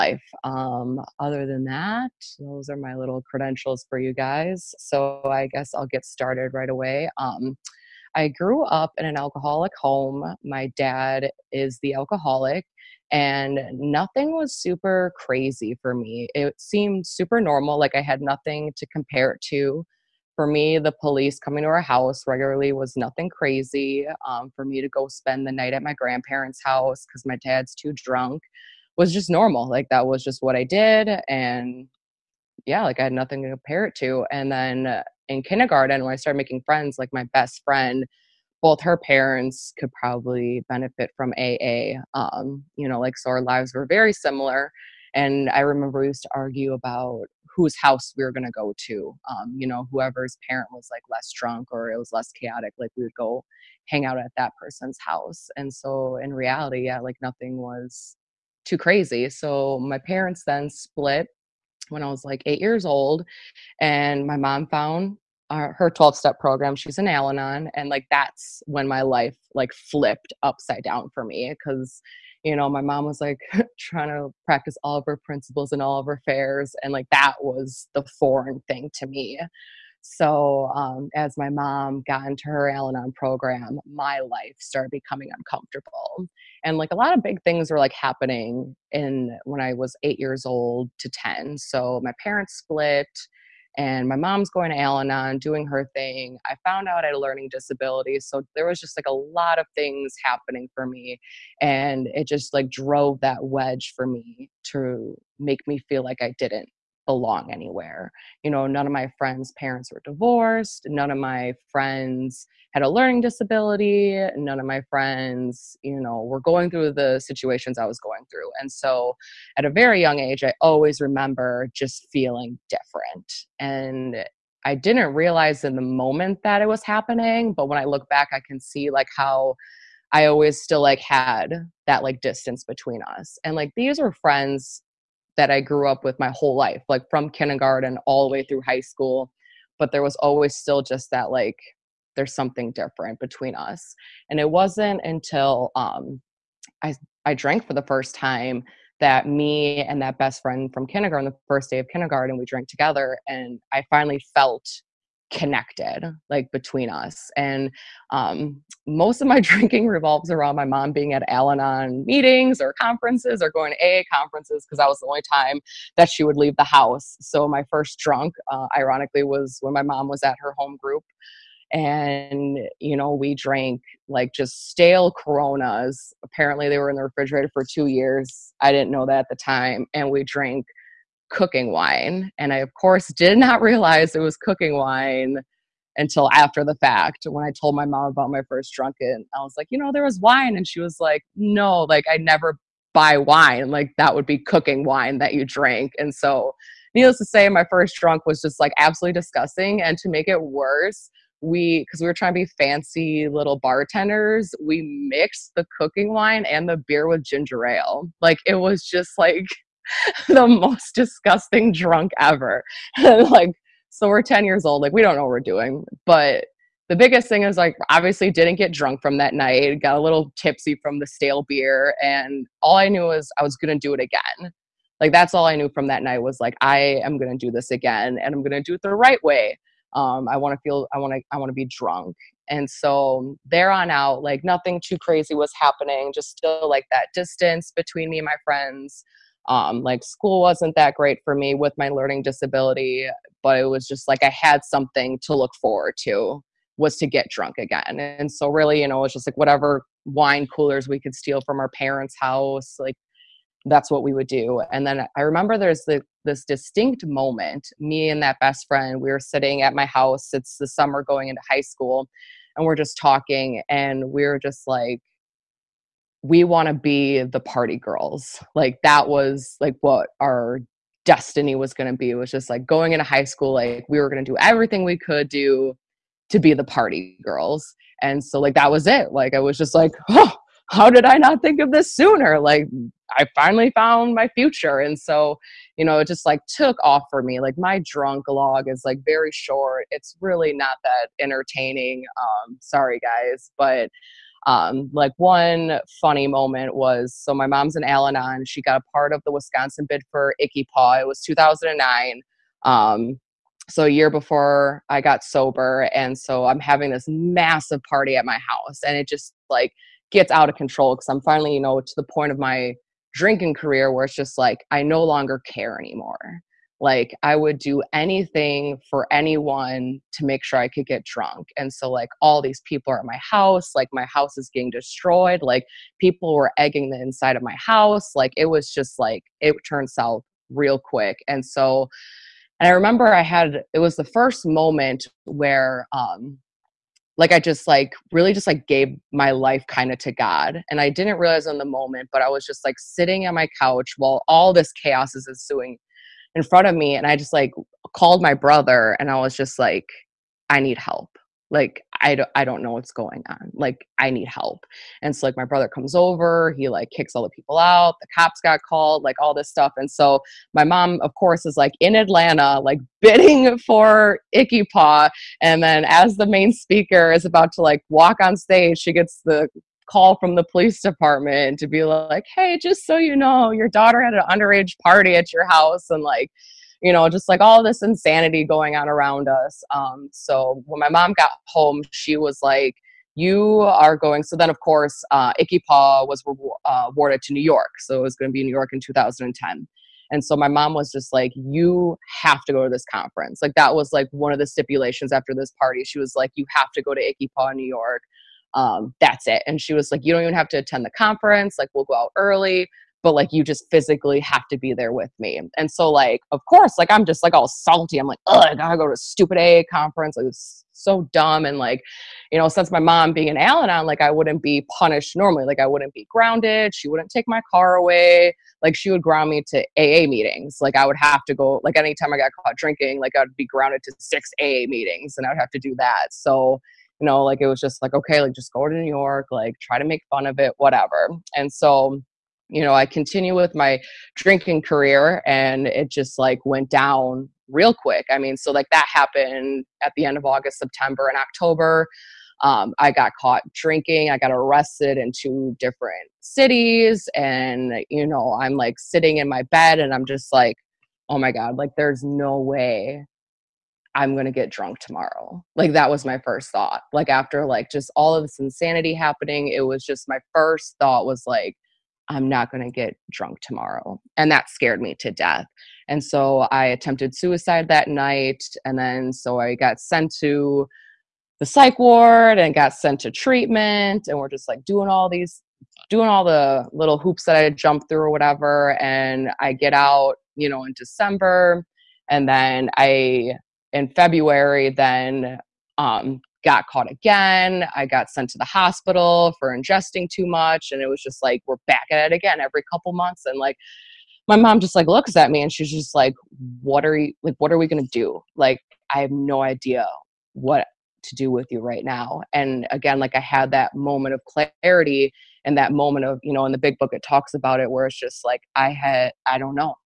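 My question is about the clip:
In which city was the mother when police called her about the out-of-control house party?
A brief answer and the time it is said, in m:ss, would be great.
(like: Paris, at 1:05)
Atlanta, at 6:01.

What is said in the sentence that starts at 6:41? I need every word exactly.
Like, we'll go out early, but like, you just physically have to be there with me.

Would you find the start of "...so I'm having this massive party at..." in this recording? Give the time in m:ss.
5:06.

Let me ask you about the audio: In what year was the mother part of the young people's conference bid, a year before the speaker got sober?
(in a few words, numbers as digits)
2009.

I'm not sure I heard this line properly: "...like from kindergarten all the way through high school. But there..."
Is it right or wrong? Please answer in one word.
right.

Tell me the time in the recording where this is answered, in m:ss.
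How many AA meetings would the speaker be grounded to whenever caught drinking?
7:03.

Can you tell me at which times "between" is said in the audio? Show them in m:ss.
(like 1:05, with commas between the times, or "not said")
2:12, 2:23, 2:36, 3:57.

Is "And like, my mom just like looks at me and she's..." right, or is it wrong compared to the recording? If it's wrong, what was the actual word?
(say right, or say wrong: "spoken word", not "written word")
right.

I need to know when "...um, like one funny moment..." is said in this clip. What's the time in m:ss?
4:54.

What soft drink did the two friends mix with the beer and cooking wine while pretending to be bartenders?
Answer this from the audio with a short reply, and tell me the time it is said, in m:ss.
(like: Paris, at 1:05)
Ginger ale, at 3:27.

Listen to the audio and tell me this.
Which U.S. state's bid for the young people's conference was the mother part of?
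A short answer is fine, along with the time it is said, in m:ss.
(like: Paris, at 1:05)
Wisconsin, at 4:59.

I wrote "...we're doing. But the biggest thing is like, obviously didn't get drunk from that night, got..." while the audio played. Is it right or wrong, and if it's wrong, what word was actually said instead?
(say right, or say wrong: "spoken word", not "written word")
right.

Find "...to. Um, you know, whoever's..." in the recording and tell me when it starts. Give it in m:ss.
0:48.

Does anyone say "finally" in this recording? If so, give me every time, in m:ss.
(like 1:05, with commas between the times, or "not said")
2:33, 4:43, 5:11.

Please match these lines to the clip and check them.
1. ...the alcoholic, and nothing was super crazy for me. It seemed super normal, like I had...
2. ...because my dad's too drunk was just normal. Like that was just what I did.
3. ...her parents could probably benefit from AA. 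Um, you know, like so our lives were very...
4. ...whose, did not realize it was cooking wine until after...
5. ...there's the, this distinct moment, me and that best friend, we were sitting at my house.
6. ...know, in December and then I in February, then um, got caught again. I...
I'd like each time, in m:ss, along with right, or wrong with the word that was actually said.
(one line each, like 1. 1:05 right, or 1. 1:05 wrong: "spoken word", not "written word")
1. 0:11 right
2. 0:27 right
3. 0:38 right
4. 3:02 wrong: "course", not "whose"
5. 4:15 right
6. 8:00 right.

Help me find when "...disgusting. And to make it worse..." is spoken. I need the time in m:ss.
3:19.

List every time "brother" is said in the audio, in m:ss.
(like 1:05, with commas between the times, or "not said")
5:48, 5:55.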